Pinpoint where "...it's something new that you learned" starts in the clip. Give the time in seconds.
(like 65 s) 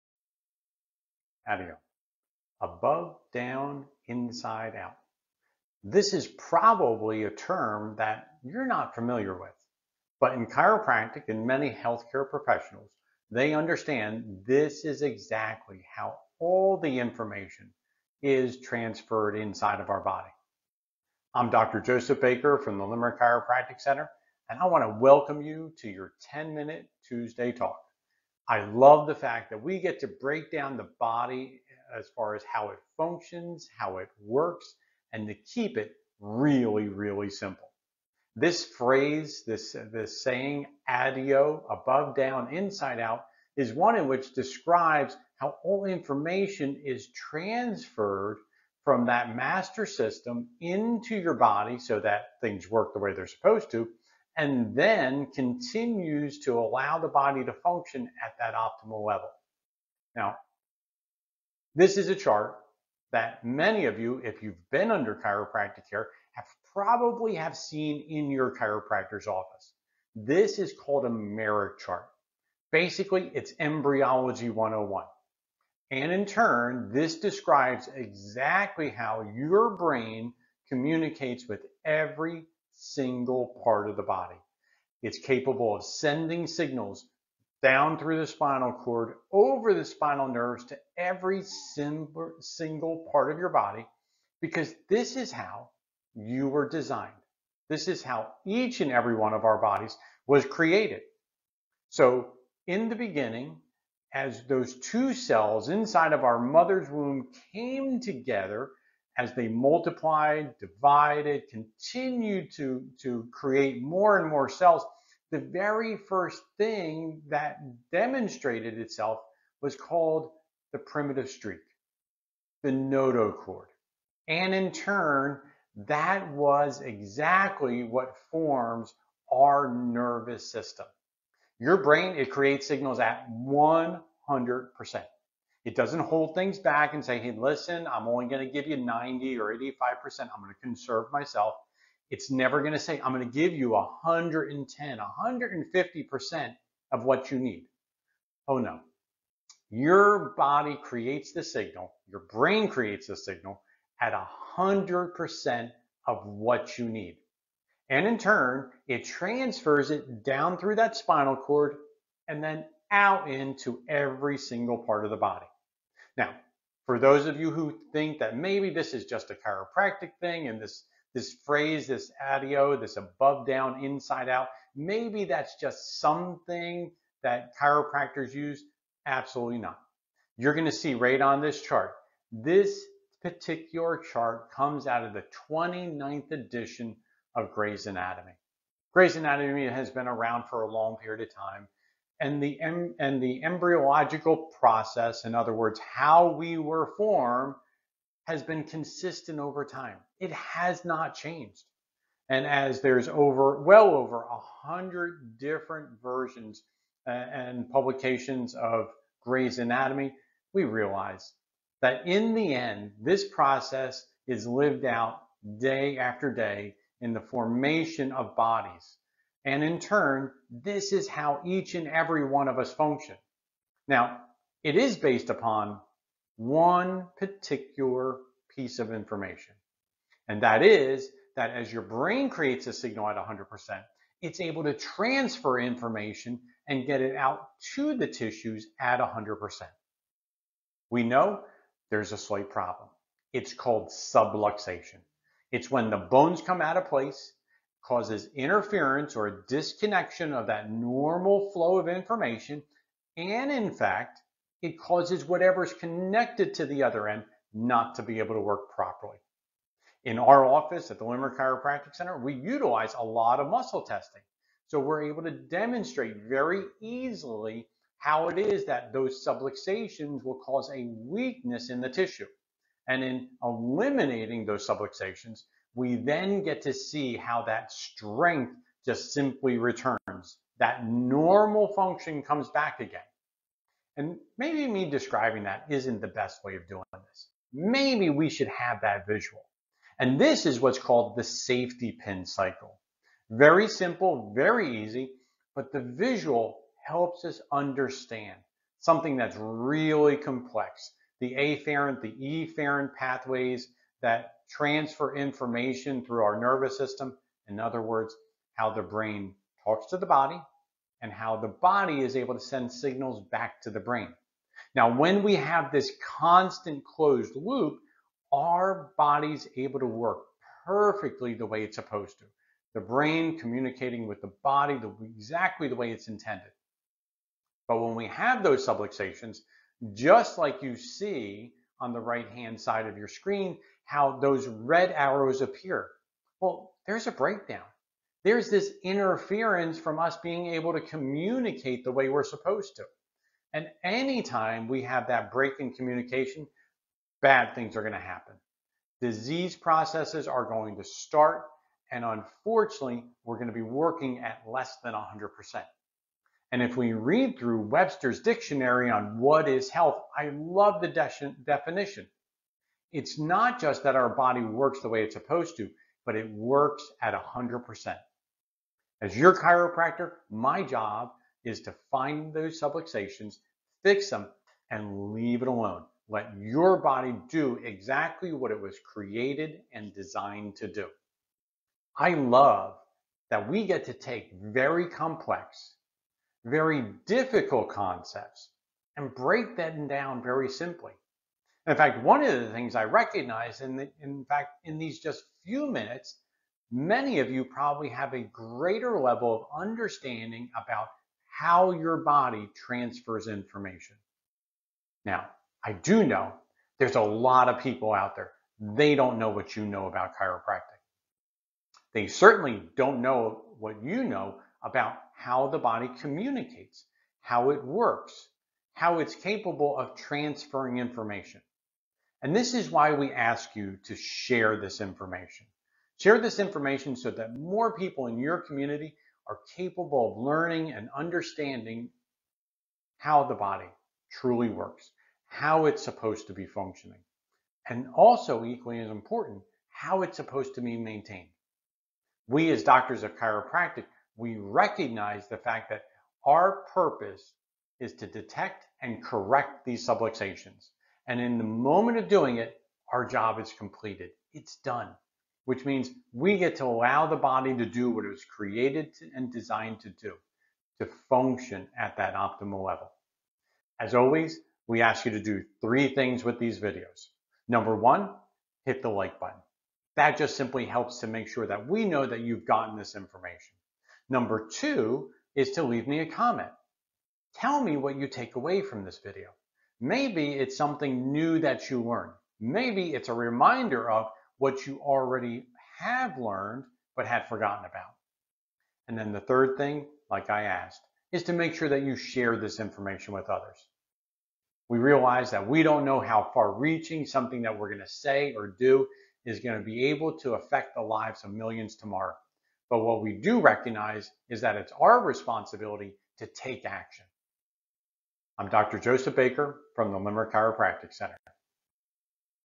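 480 s.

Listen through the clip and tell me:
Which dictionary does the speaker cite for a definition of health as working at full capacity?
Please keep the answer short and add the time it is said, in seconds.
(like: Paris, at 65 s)
Webster's, at 357 s.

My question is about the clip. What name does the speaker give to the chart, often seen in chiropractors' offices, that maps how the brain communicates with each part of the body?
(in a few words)
Meric chart.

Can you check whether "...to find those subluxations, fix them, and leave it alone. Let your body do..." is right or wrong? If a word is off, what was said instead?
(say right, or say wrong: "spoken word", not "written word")
right.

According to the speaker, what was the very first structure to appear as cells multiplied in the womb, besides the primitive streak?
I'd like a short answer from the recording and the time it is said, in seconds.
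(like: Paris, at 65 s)
notochord, at 122 s.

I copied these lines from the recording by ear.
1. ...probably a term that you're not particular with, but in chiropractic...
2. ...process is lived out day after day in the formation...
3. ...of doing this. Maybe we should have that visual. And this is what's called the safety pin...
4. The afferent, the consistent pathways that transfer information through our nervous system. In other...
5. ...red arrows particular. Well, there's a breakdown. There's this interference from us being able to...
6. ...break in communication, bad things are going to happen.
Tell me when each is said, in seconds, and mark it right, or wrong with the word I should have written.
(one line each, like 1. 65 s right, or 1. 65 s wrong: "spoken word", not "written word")
1. 6 s wrong: "familiar", not "particular"
2. 213 s right
3. 286 s right
4. 301 s wrong: "efferent", not "consistent"
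5. 334 s wrong: "appear", not "particular"
6. 345 s right.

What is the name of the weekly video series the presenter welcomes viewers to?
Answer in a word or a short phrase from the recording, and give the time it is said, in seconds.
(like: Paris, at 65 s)
10 minute Tuesday talk, at 26 s.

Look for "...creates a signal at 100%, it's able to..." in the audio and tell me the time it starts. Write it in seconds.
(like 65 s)
232 s.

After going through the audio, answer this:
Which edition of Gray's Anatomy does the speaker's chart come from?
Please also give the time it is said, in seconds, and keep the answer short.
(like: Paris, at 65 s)
29th, at 185 s.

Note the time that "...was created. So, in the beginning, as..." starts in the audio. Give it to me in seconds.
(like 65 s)
100 s.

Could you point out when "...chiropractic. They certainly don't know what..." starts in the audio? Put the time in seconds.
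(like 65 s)
410 s.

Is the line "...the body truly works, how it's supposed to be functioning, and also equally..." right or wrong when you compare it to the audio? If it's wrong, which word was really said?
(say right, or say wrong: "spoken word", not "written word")
right.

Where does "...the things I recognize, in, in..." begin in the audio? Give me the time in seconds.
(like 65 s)
392 s.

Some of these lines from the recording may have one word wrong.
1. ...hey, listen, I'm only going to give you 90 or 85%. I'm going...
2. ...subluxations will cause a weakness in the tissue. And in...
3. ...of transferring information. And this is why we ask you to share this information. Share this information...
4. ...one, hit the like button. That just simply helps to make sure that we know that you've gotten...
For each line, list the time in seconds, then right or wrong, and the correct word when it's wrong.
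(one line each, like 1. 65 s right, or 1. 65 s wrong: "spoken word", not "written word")
1. 137 s right
2. 269 s right
3. 419 s right
4. 467 s right.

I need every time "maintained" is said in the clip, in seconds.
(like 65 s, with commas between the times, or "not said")
440 s.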